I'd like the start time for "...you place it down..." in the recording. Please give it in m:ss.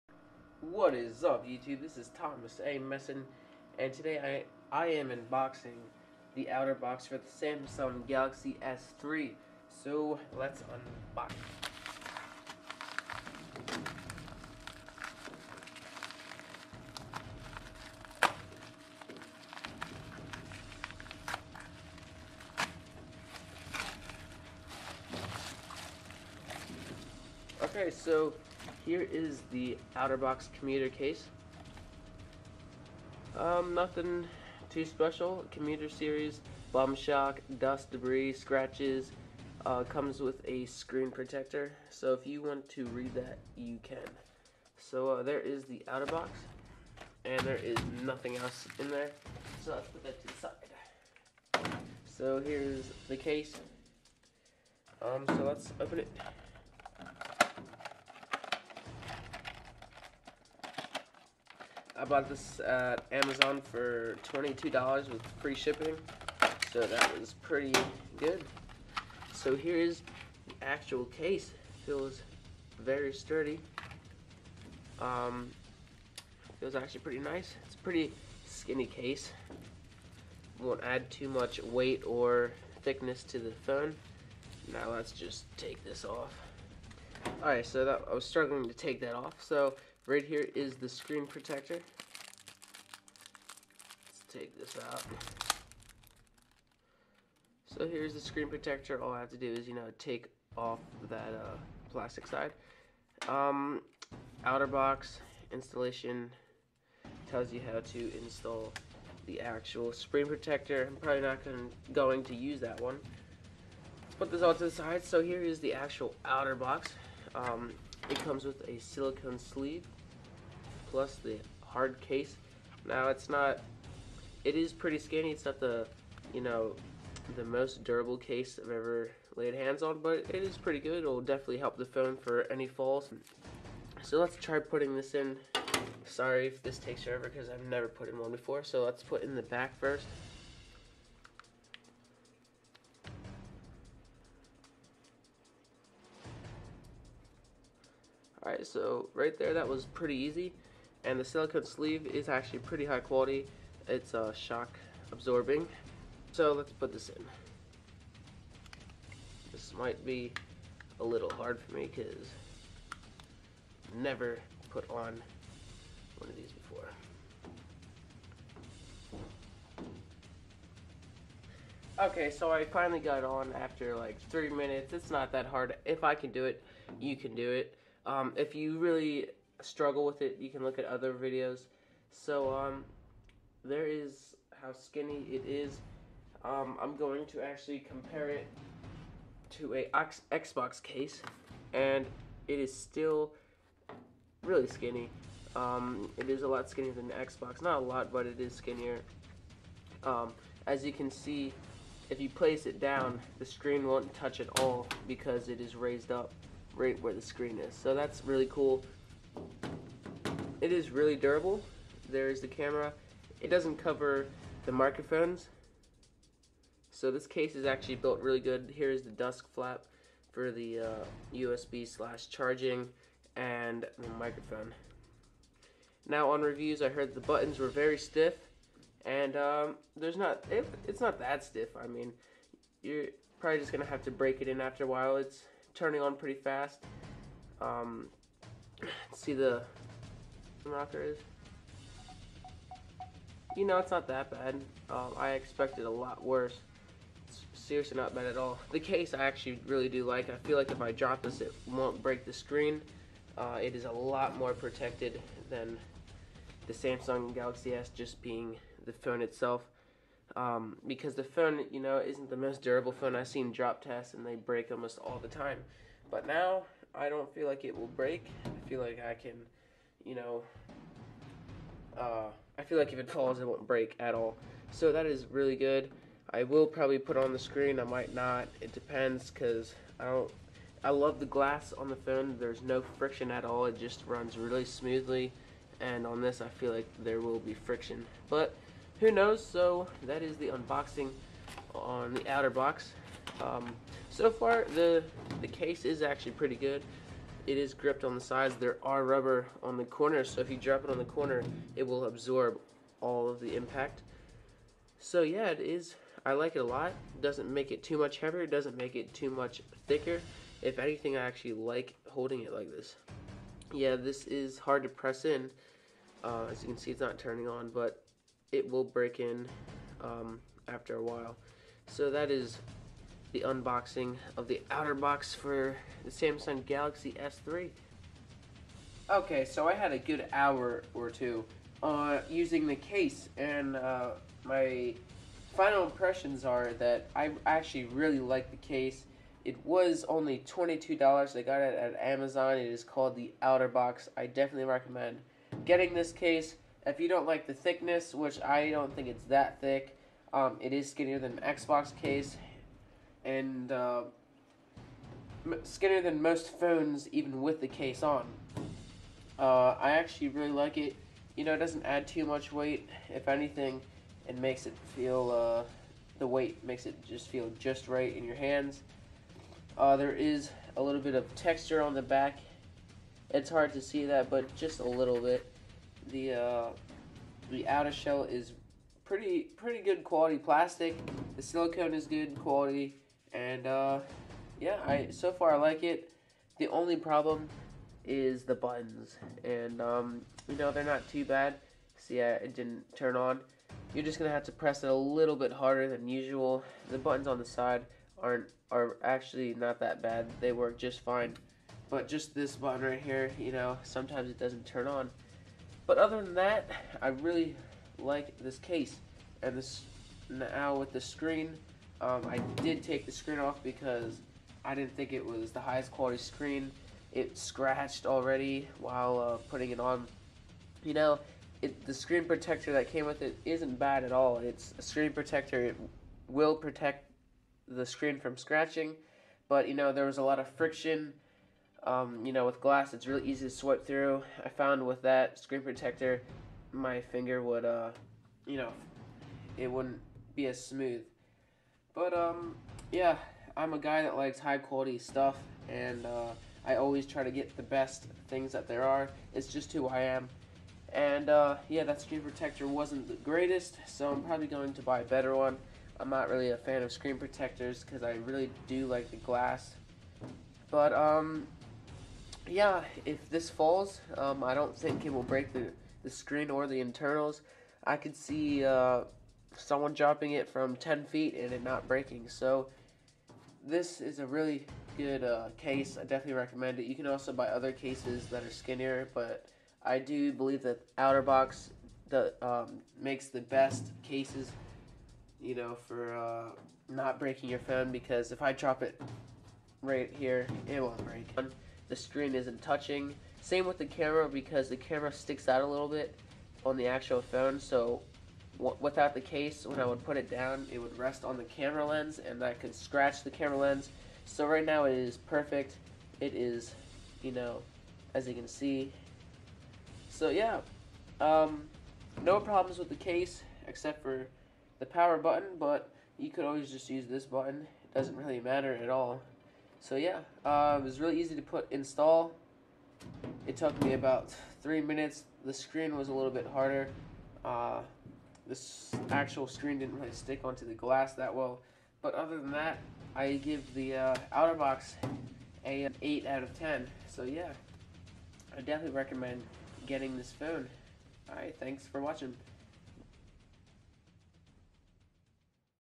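3:22.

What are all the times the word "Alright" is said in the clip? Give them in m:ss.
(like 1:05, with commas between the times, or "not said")
1:27, 2:28, 9:01.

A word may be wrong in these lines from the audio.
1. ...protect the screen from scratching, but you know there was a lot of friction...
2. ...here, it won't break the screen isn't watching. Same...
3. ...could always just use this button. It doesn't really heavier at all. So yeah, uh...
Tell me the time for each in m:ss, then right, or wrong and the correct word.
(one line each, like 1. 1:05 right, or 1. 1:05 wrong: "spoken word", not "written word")
1. 7:06 right
2. 8:10 wrong: "touching", not "watching"
3. 8:36 wrong: "matter", not "heavier".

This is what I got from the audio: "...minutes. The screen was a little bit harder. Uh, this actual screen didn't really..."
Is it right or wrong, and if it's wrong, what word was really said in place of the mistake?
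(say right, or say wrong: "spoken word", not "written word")
right.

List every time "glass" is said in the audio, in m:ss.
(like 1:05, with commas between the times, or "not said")
4:41, 7:12, 7:39, 8:50.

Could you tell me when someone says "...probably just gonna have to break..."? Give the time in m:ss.
3:53.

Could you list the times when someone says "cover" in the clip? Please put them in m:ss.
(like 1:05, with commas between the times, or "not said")
3:33.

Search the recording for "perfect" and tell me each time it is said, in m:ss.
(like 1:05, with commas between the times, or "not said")
8:25.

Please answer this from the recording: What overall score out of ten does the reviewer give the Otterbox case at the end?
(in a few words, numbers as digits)
8.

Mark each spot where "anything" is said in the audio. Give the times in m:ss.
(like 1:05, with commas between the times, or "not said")
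5:10, 6:03.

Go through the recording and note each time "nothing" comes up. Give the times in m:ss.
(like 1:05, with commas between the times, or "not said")
0:33, 0:48.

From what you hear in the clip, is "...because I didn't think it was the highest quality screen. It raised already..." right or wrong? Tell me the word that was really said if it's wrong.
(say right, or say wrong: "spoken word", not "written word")
wrong: "scratched", not "raised".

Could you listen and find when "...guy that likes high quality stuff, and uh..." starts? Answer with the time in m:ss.
7:23.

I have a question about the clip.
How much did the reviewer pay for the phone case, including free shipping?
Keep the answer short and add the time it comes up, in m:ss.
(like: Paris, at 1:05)
$22, at 1:04.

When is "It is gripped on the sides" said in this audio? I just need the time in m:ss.
4:57.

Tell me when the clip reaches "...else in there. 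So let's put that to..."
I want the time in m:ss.
0:48.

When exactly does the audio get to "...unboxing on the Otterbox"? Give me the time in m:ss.
4:50.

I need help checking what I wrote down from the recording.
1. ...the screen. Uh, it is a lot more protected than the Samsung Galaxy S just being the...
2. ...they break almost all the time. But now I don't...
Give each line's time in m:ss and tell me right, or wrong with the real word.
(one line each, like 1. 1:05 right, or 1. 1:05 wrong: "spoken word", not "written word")
1. 4:12 right
2. 4:24 right.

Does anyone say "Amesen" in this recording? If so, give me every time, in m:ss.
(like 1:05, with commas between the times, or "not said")
0:02.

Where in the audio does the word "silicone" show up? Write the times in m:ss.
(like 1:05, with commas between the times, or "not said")
1:58, 2:31, 6:21.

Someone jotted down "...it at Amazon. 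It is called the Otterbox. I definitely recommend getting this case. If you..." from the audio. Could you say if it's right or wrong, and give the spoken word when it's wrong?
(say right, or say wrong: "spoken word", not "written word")
right.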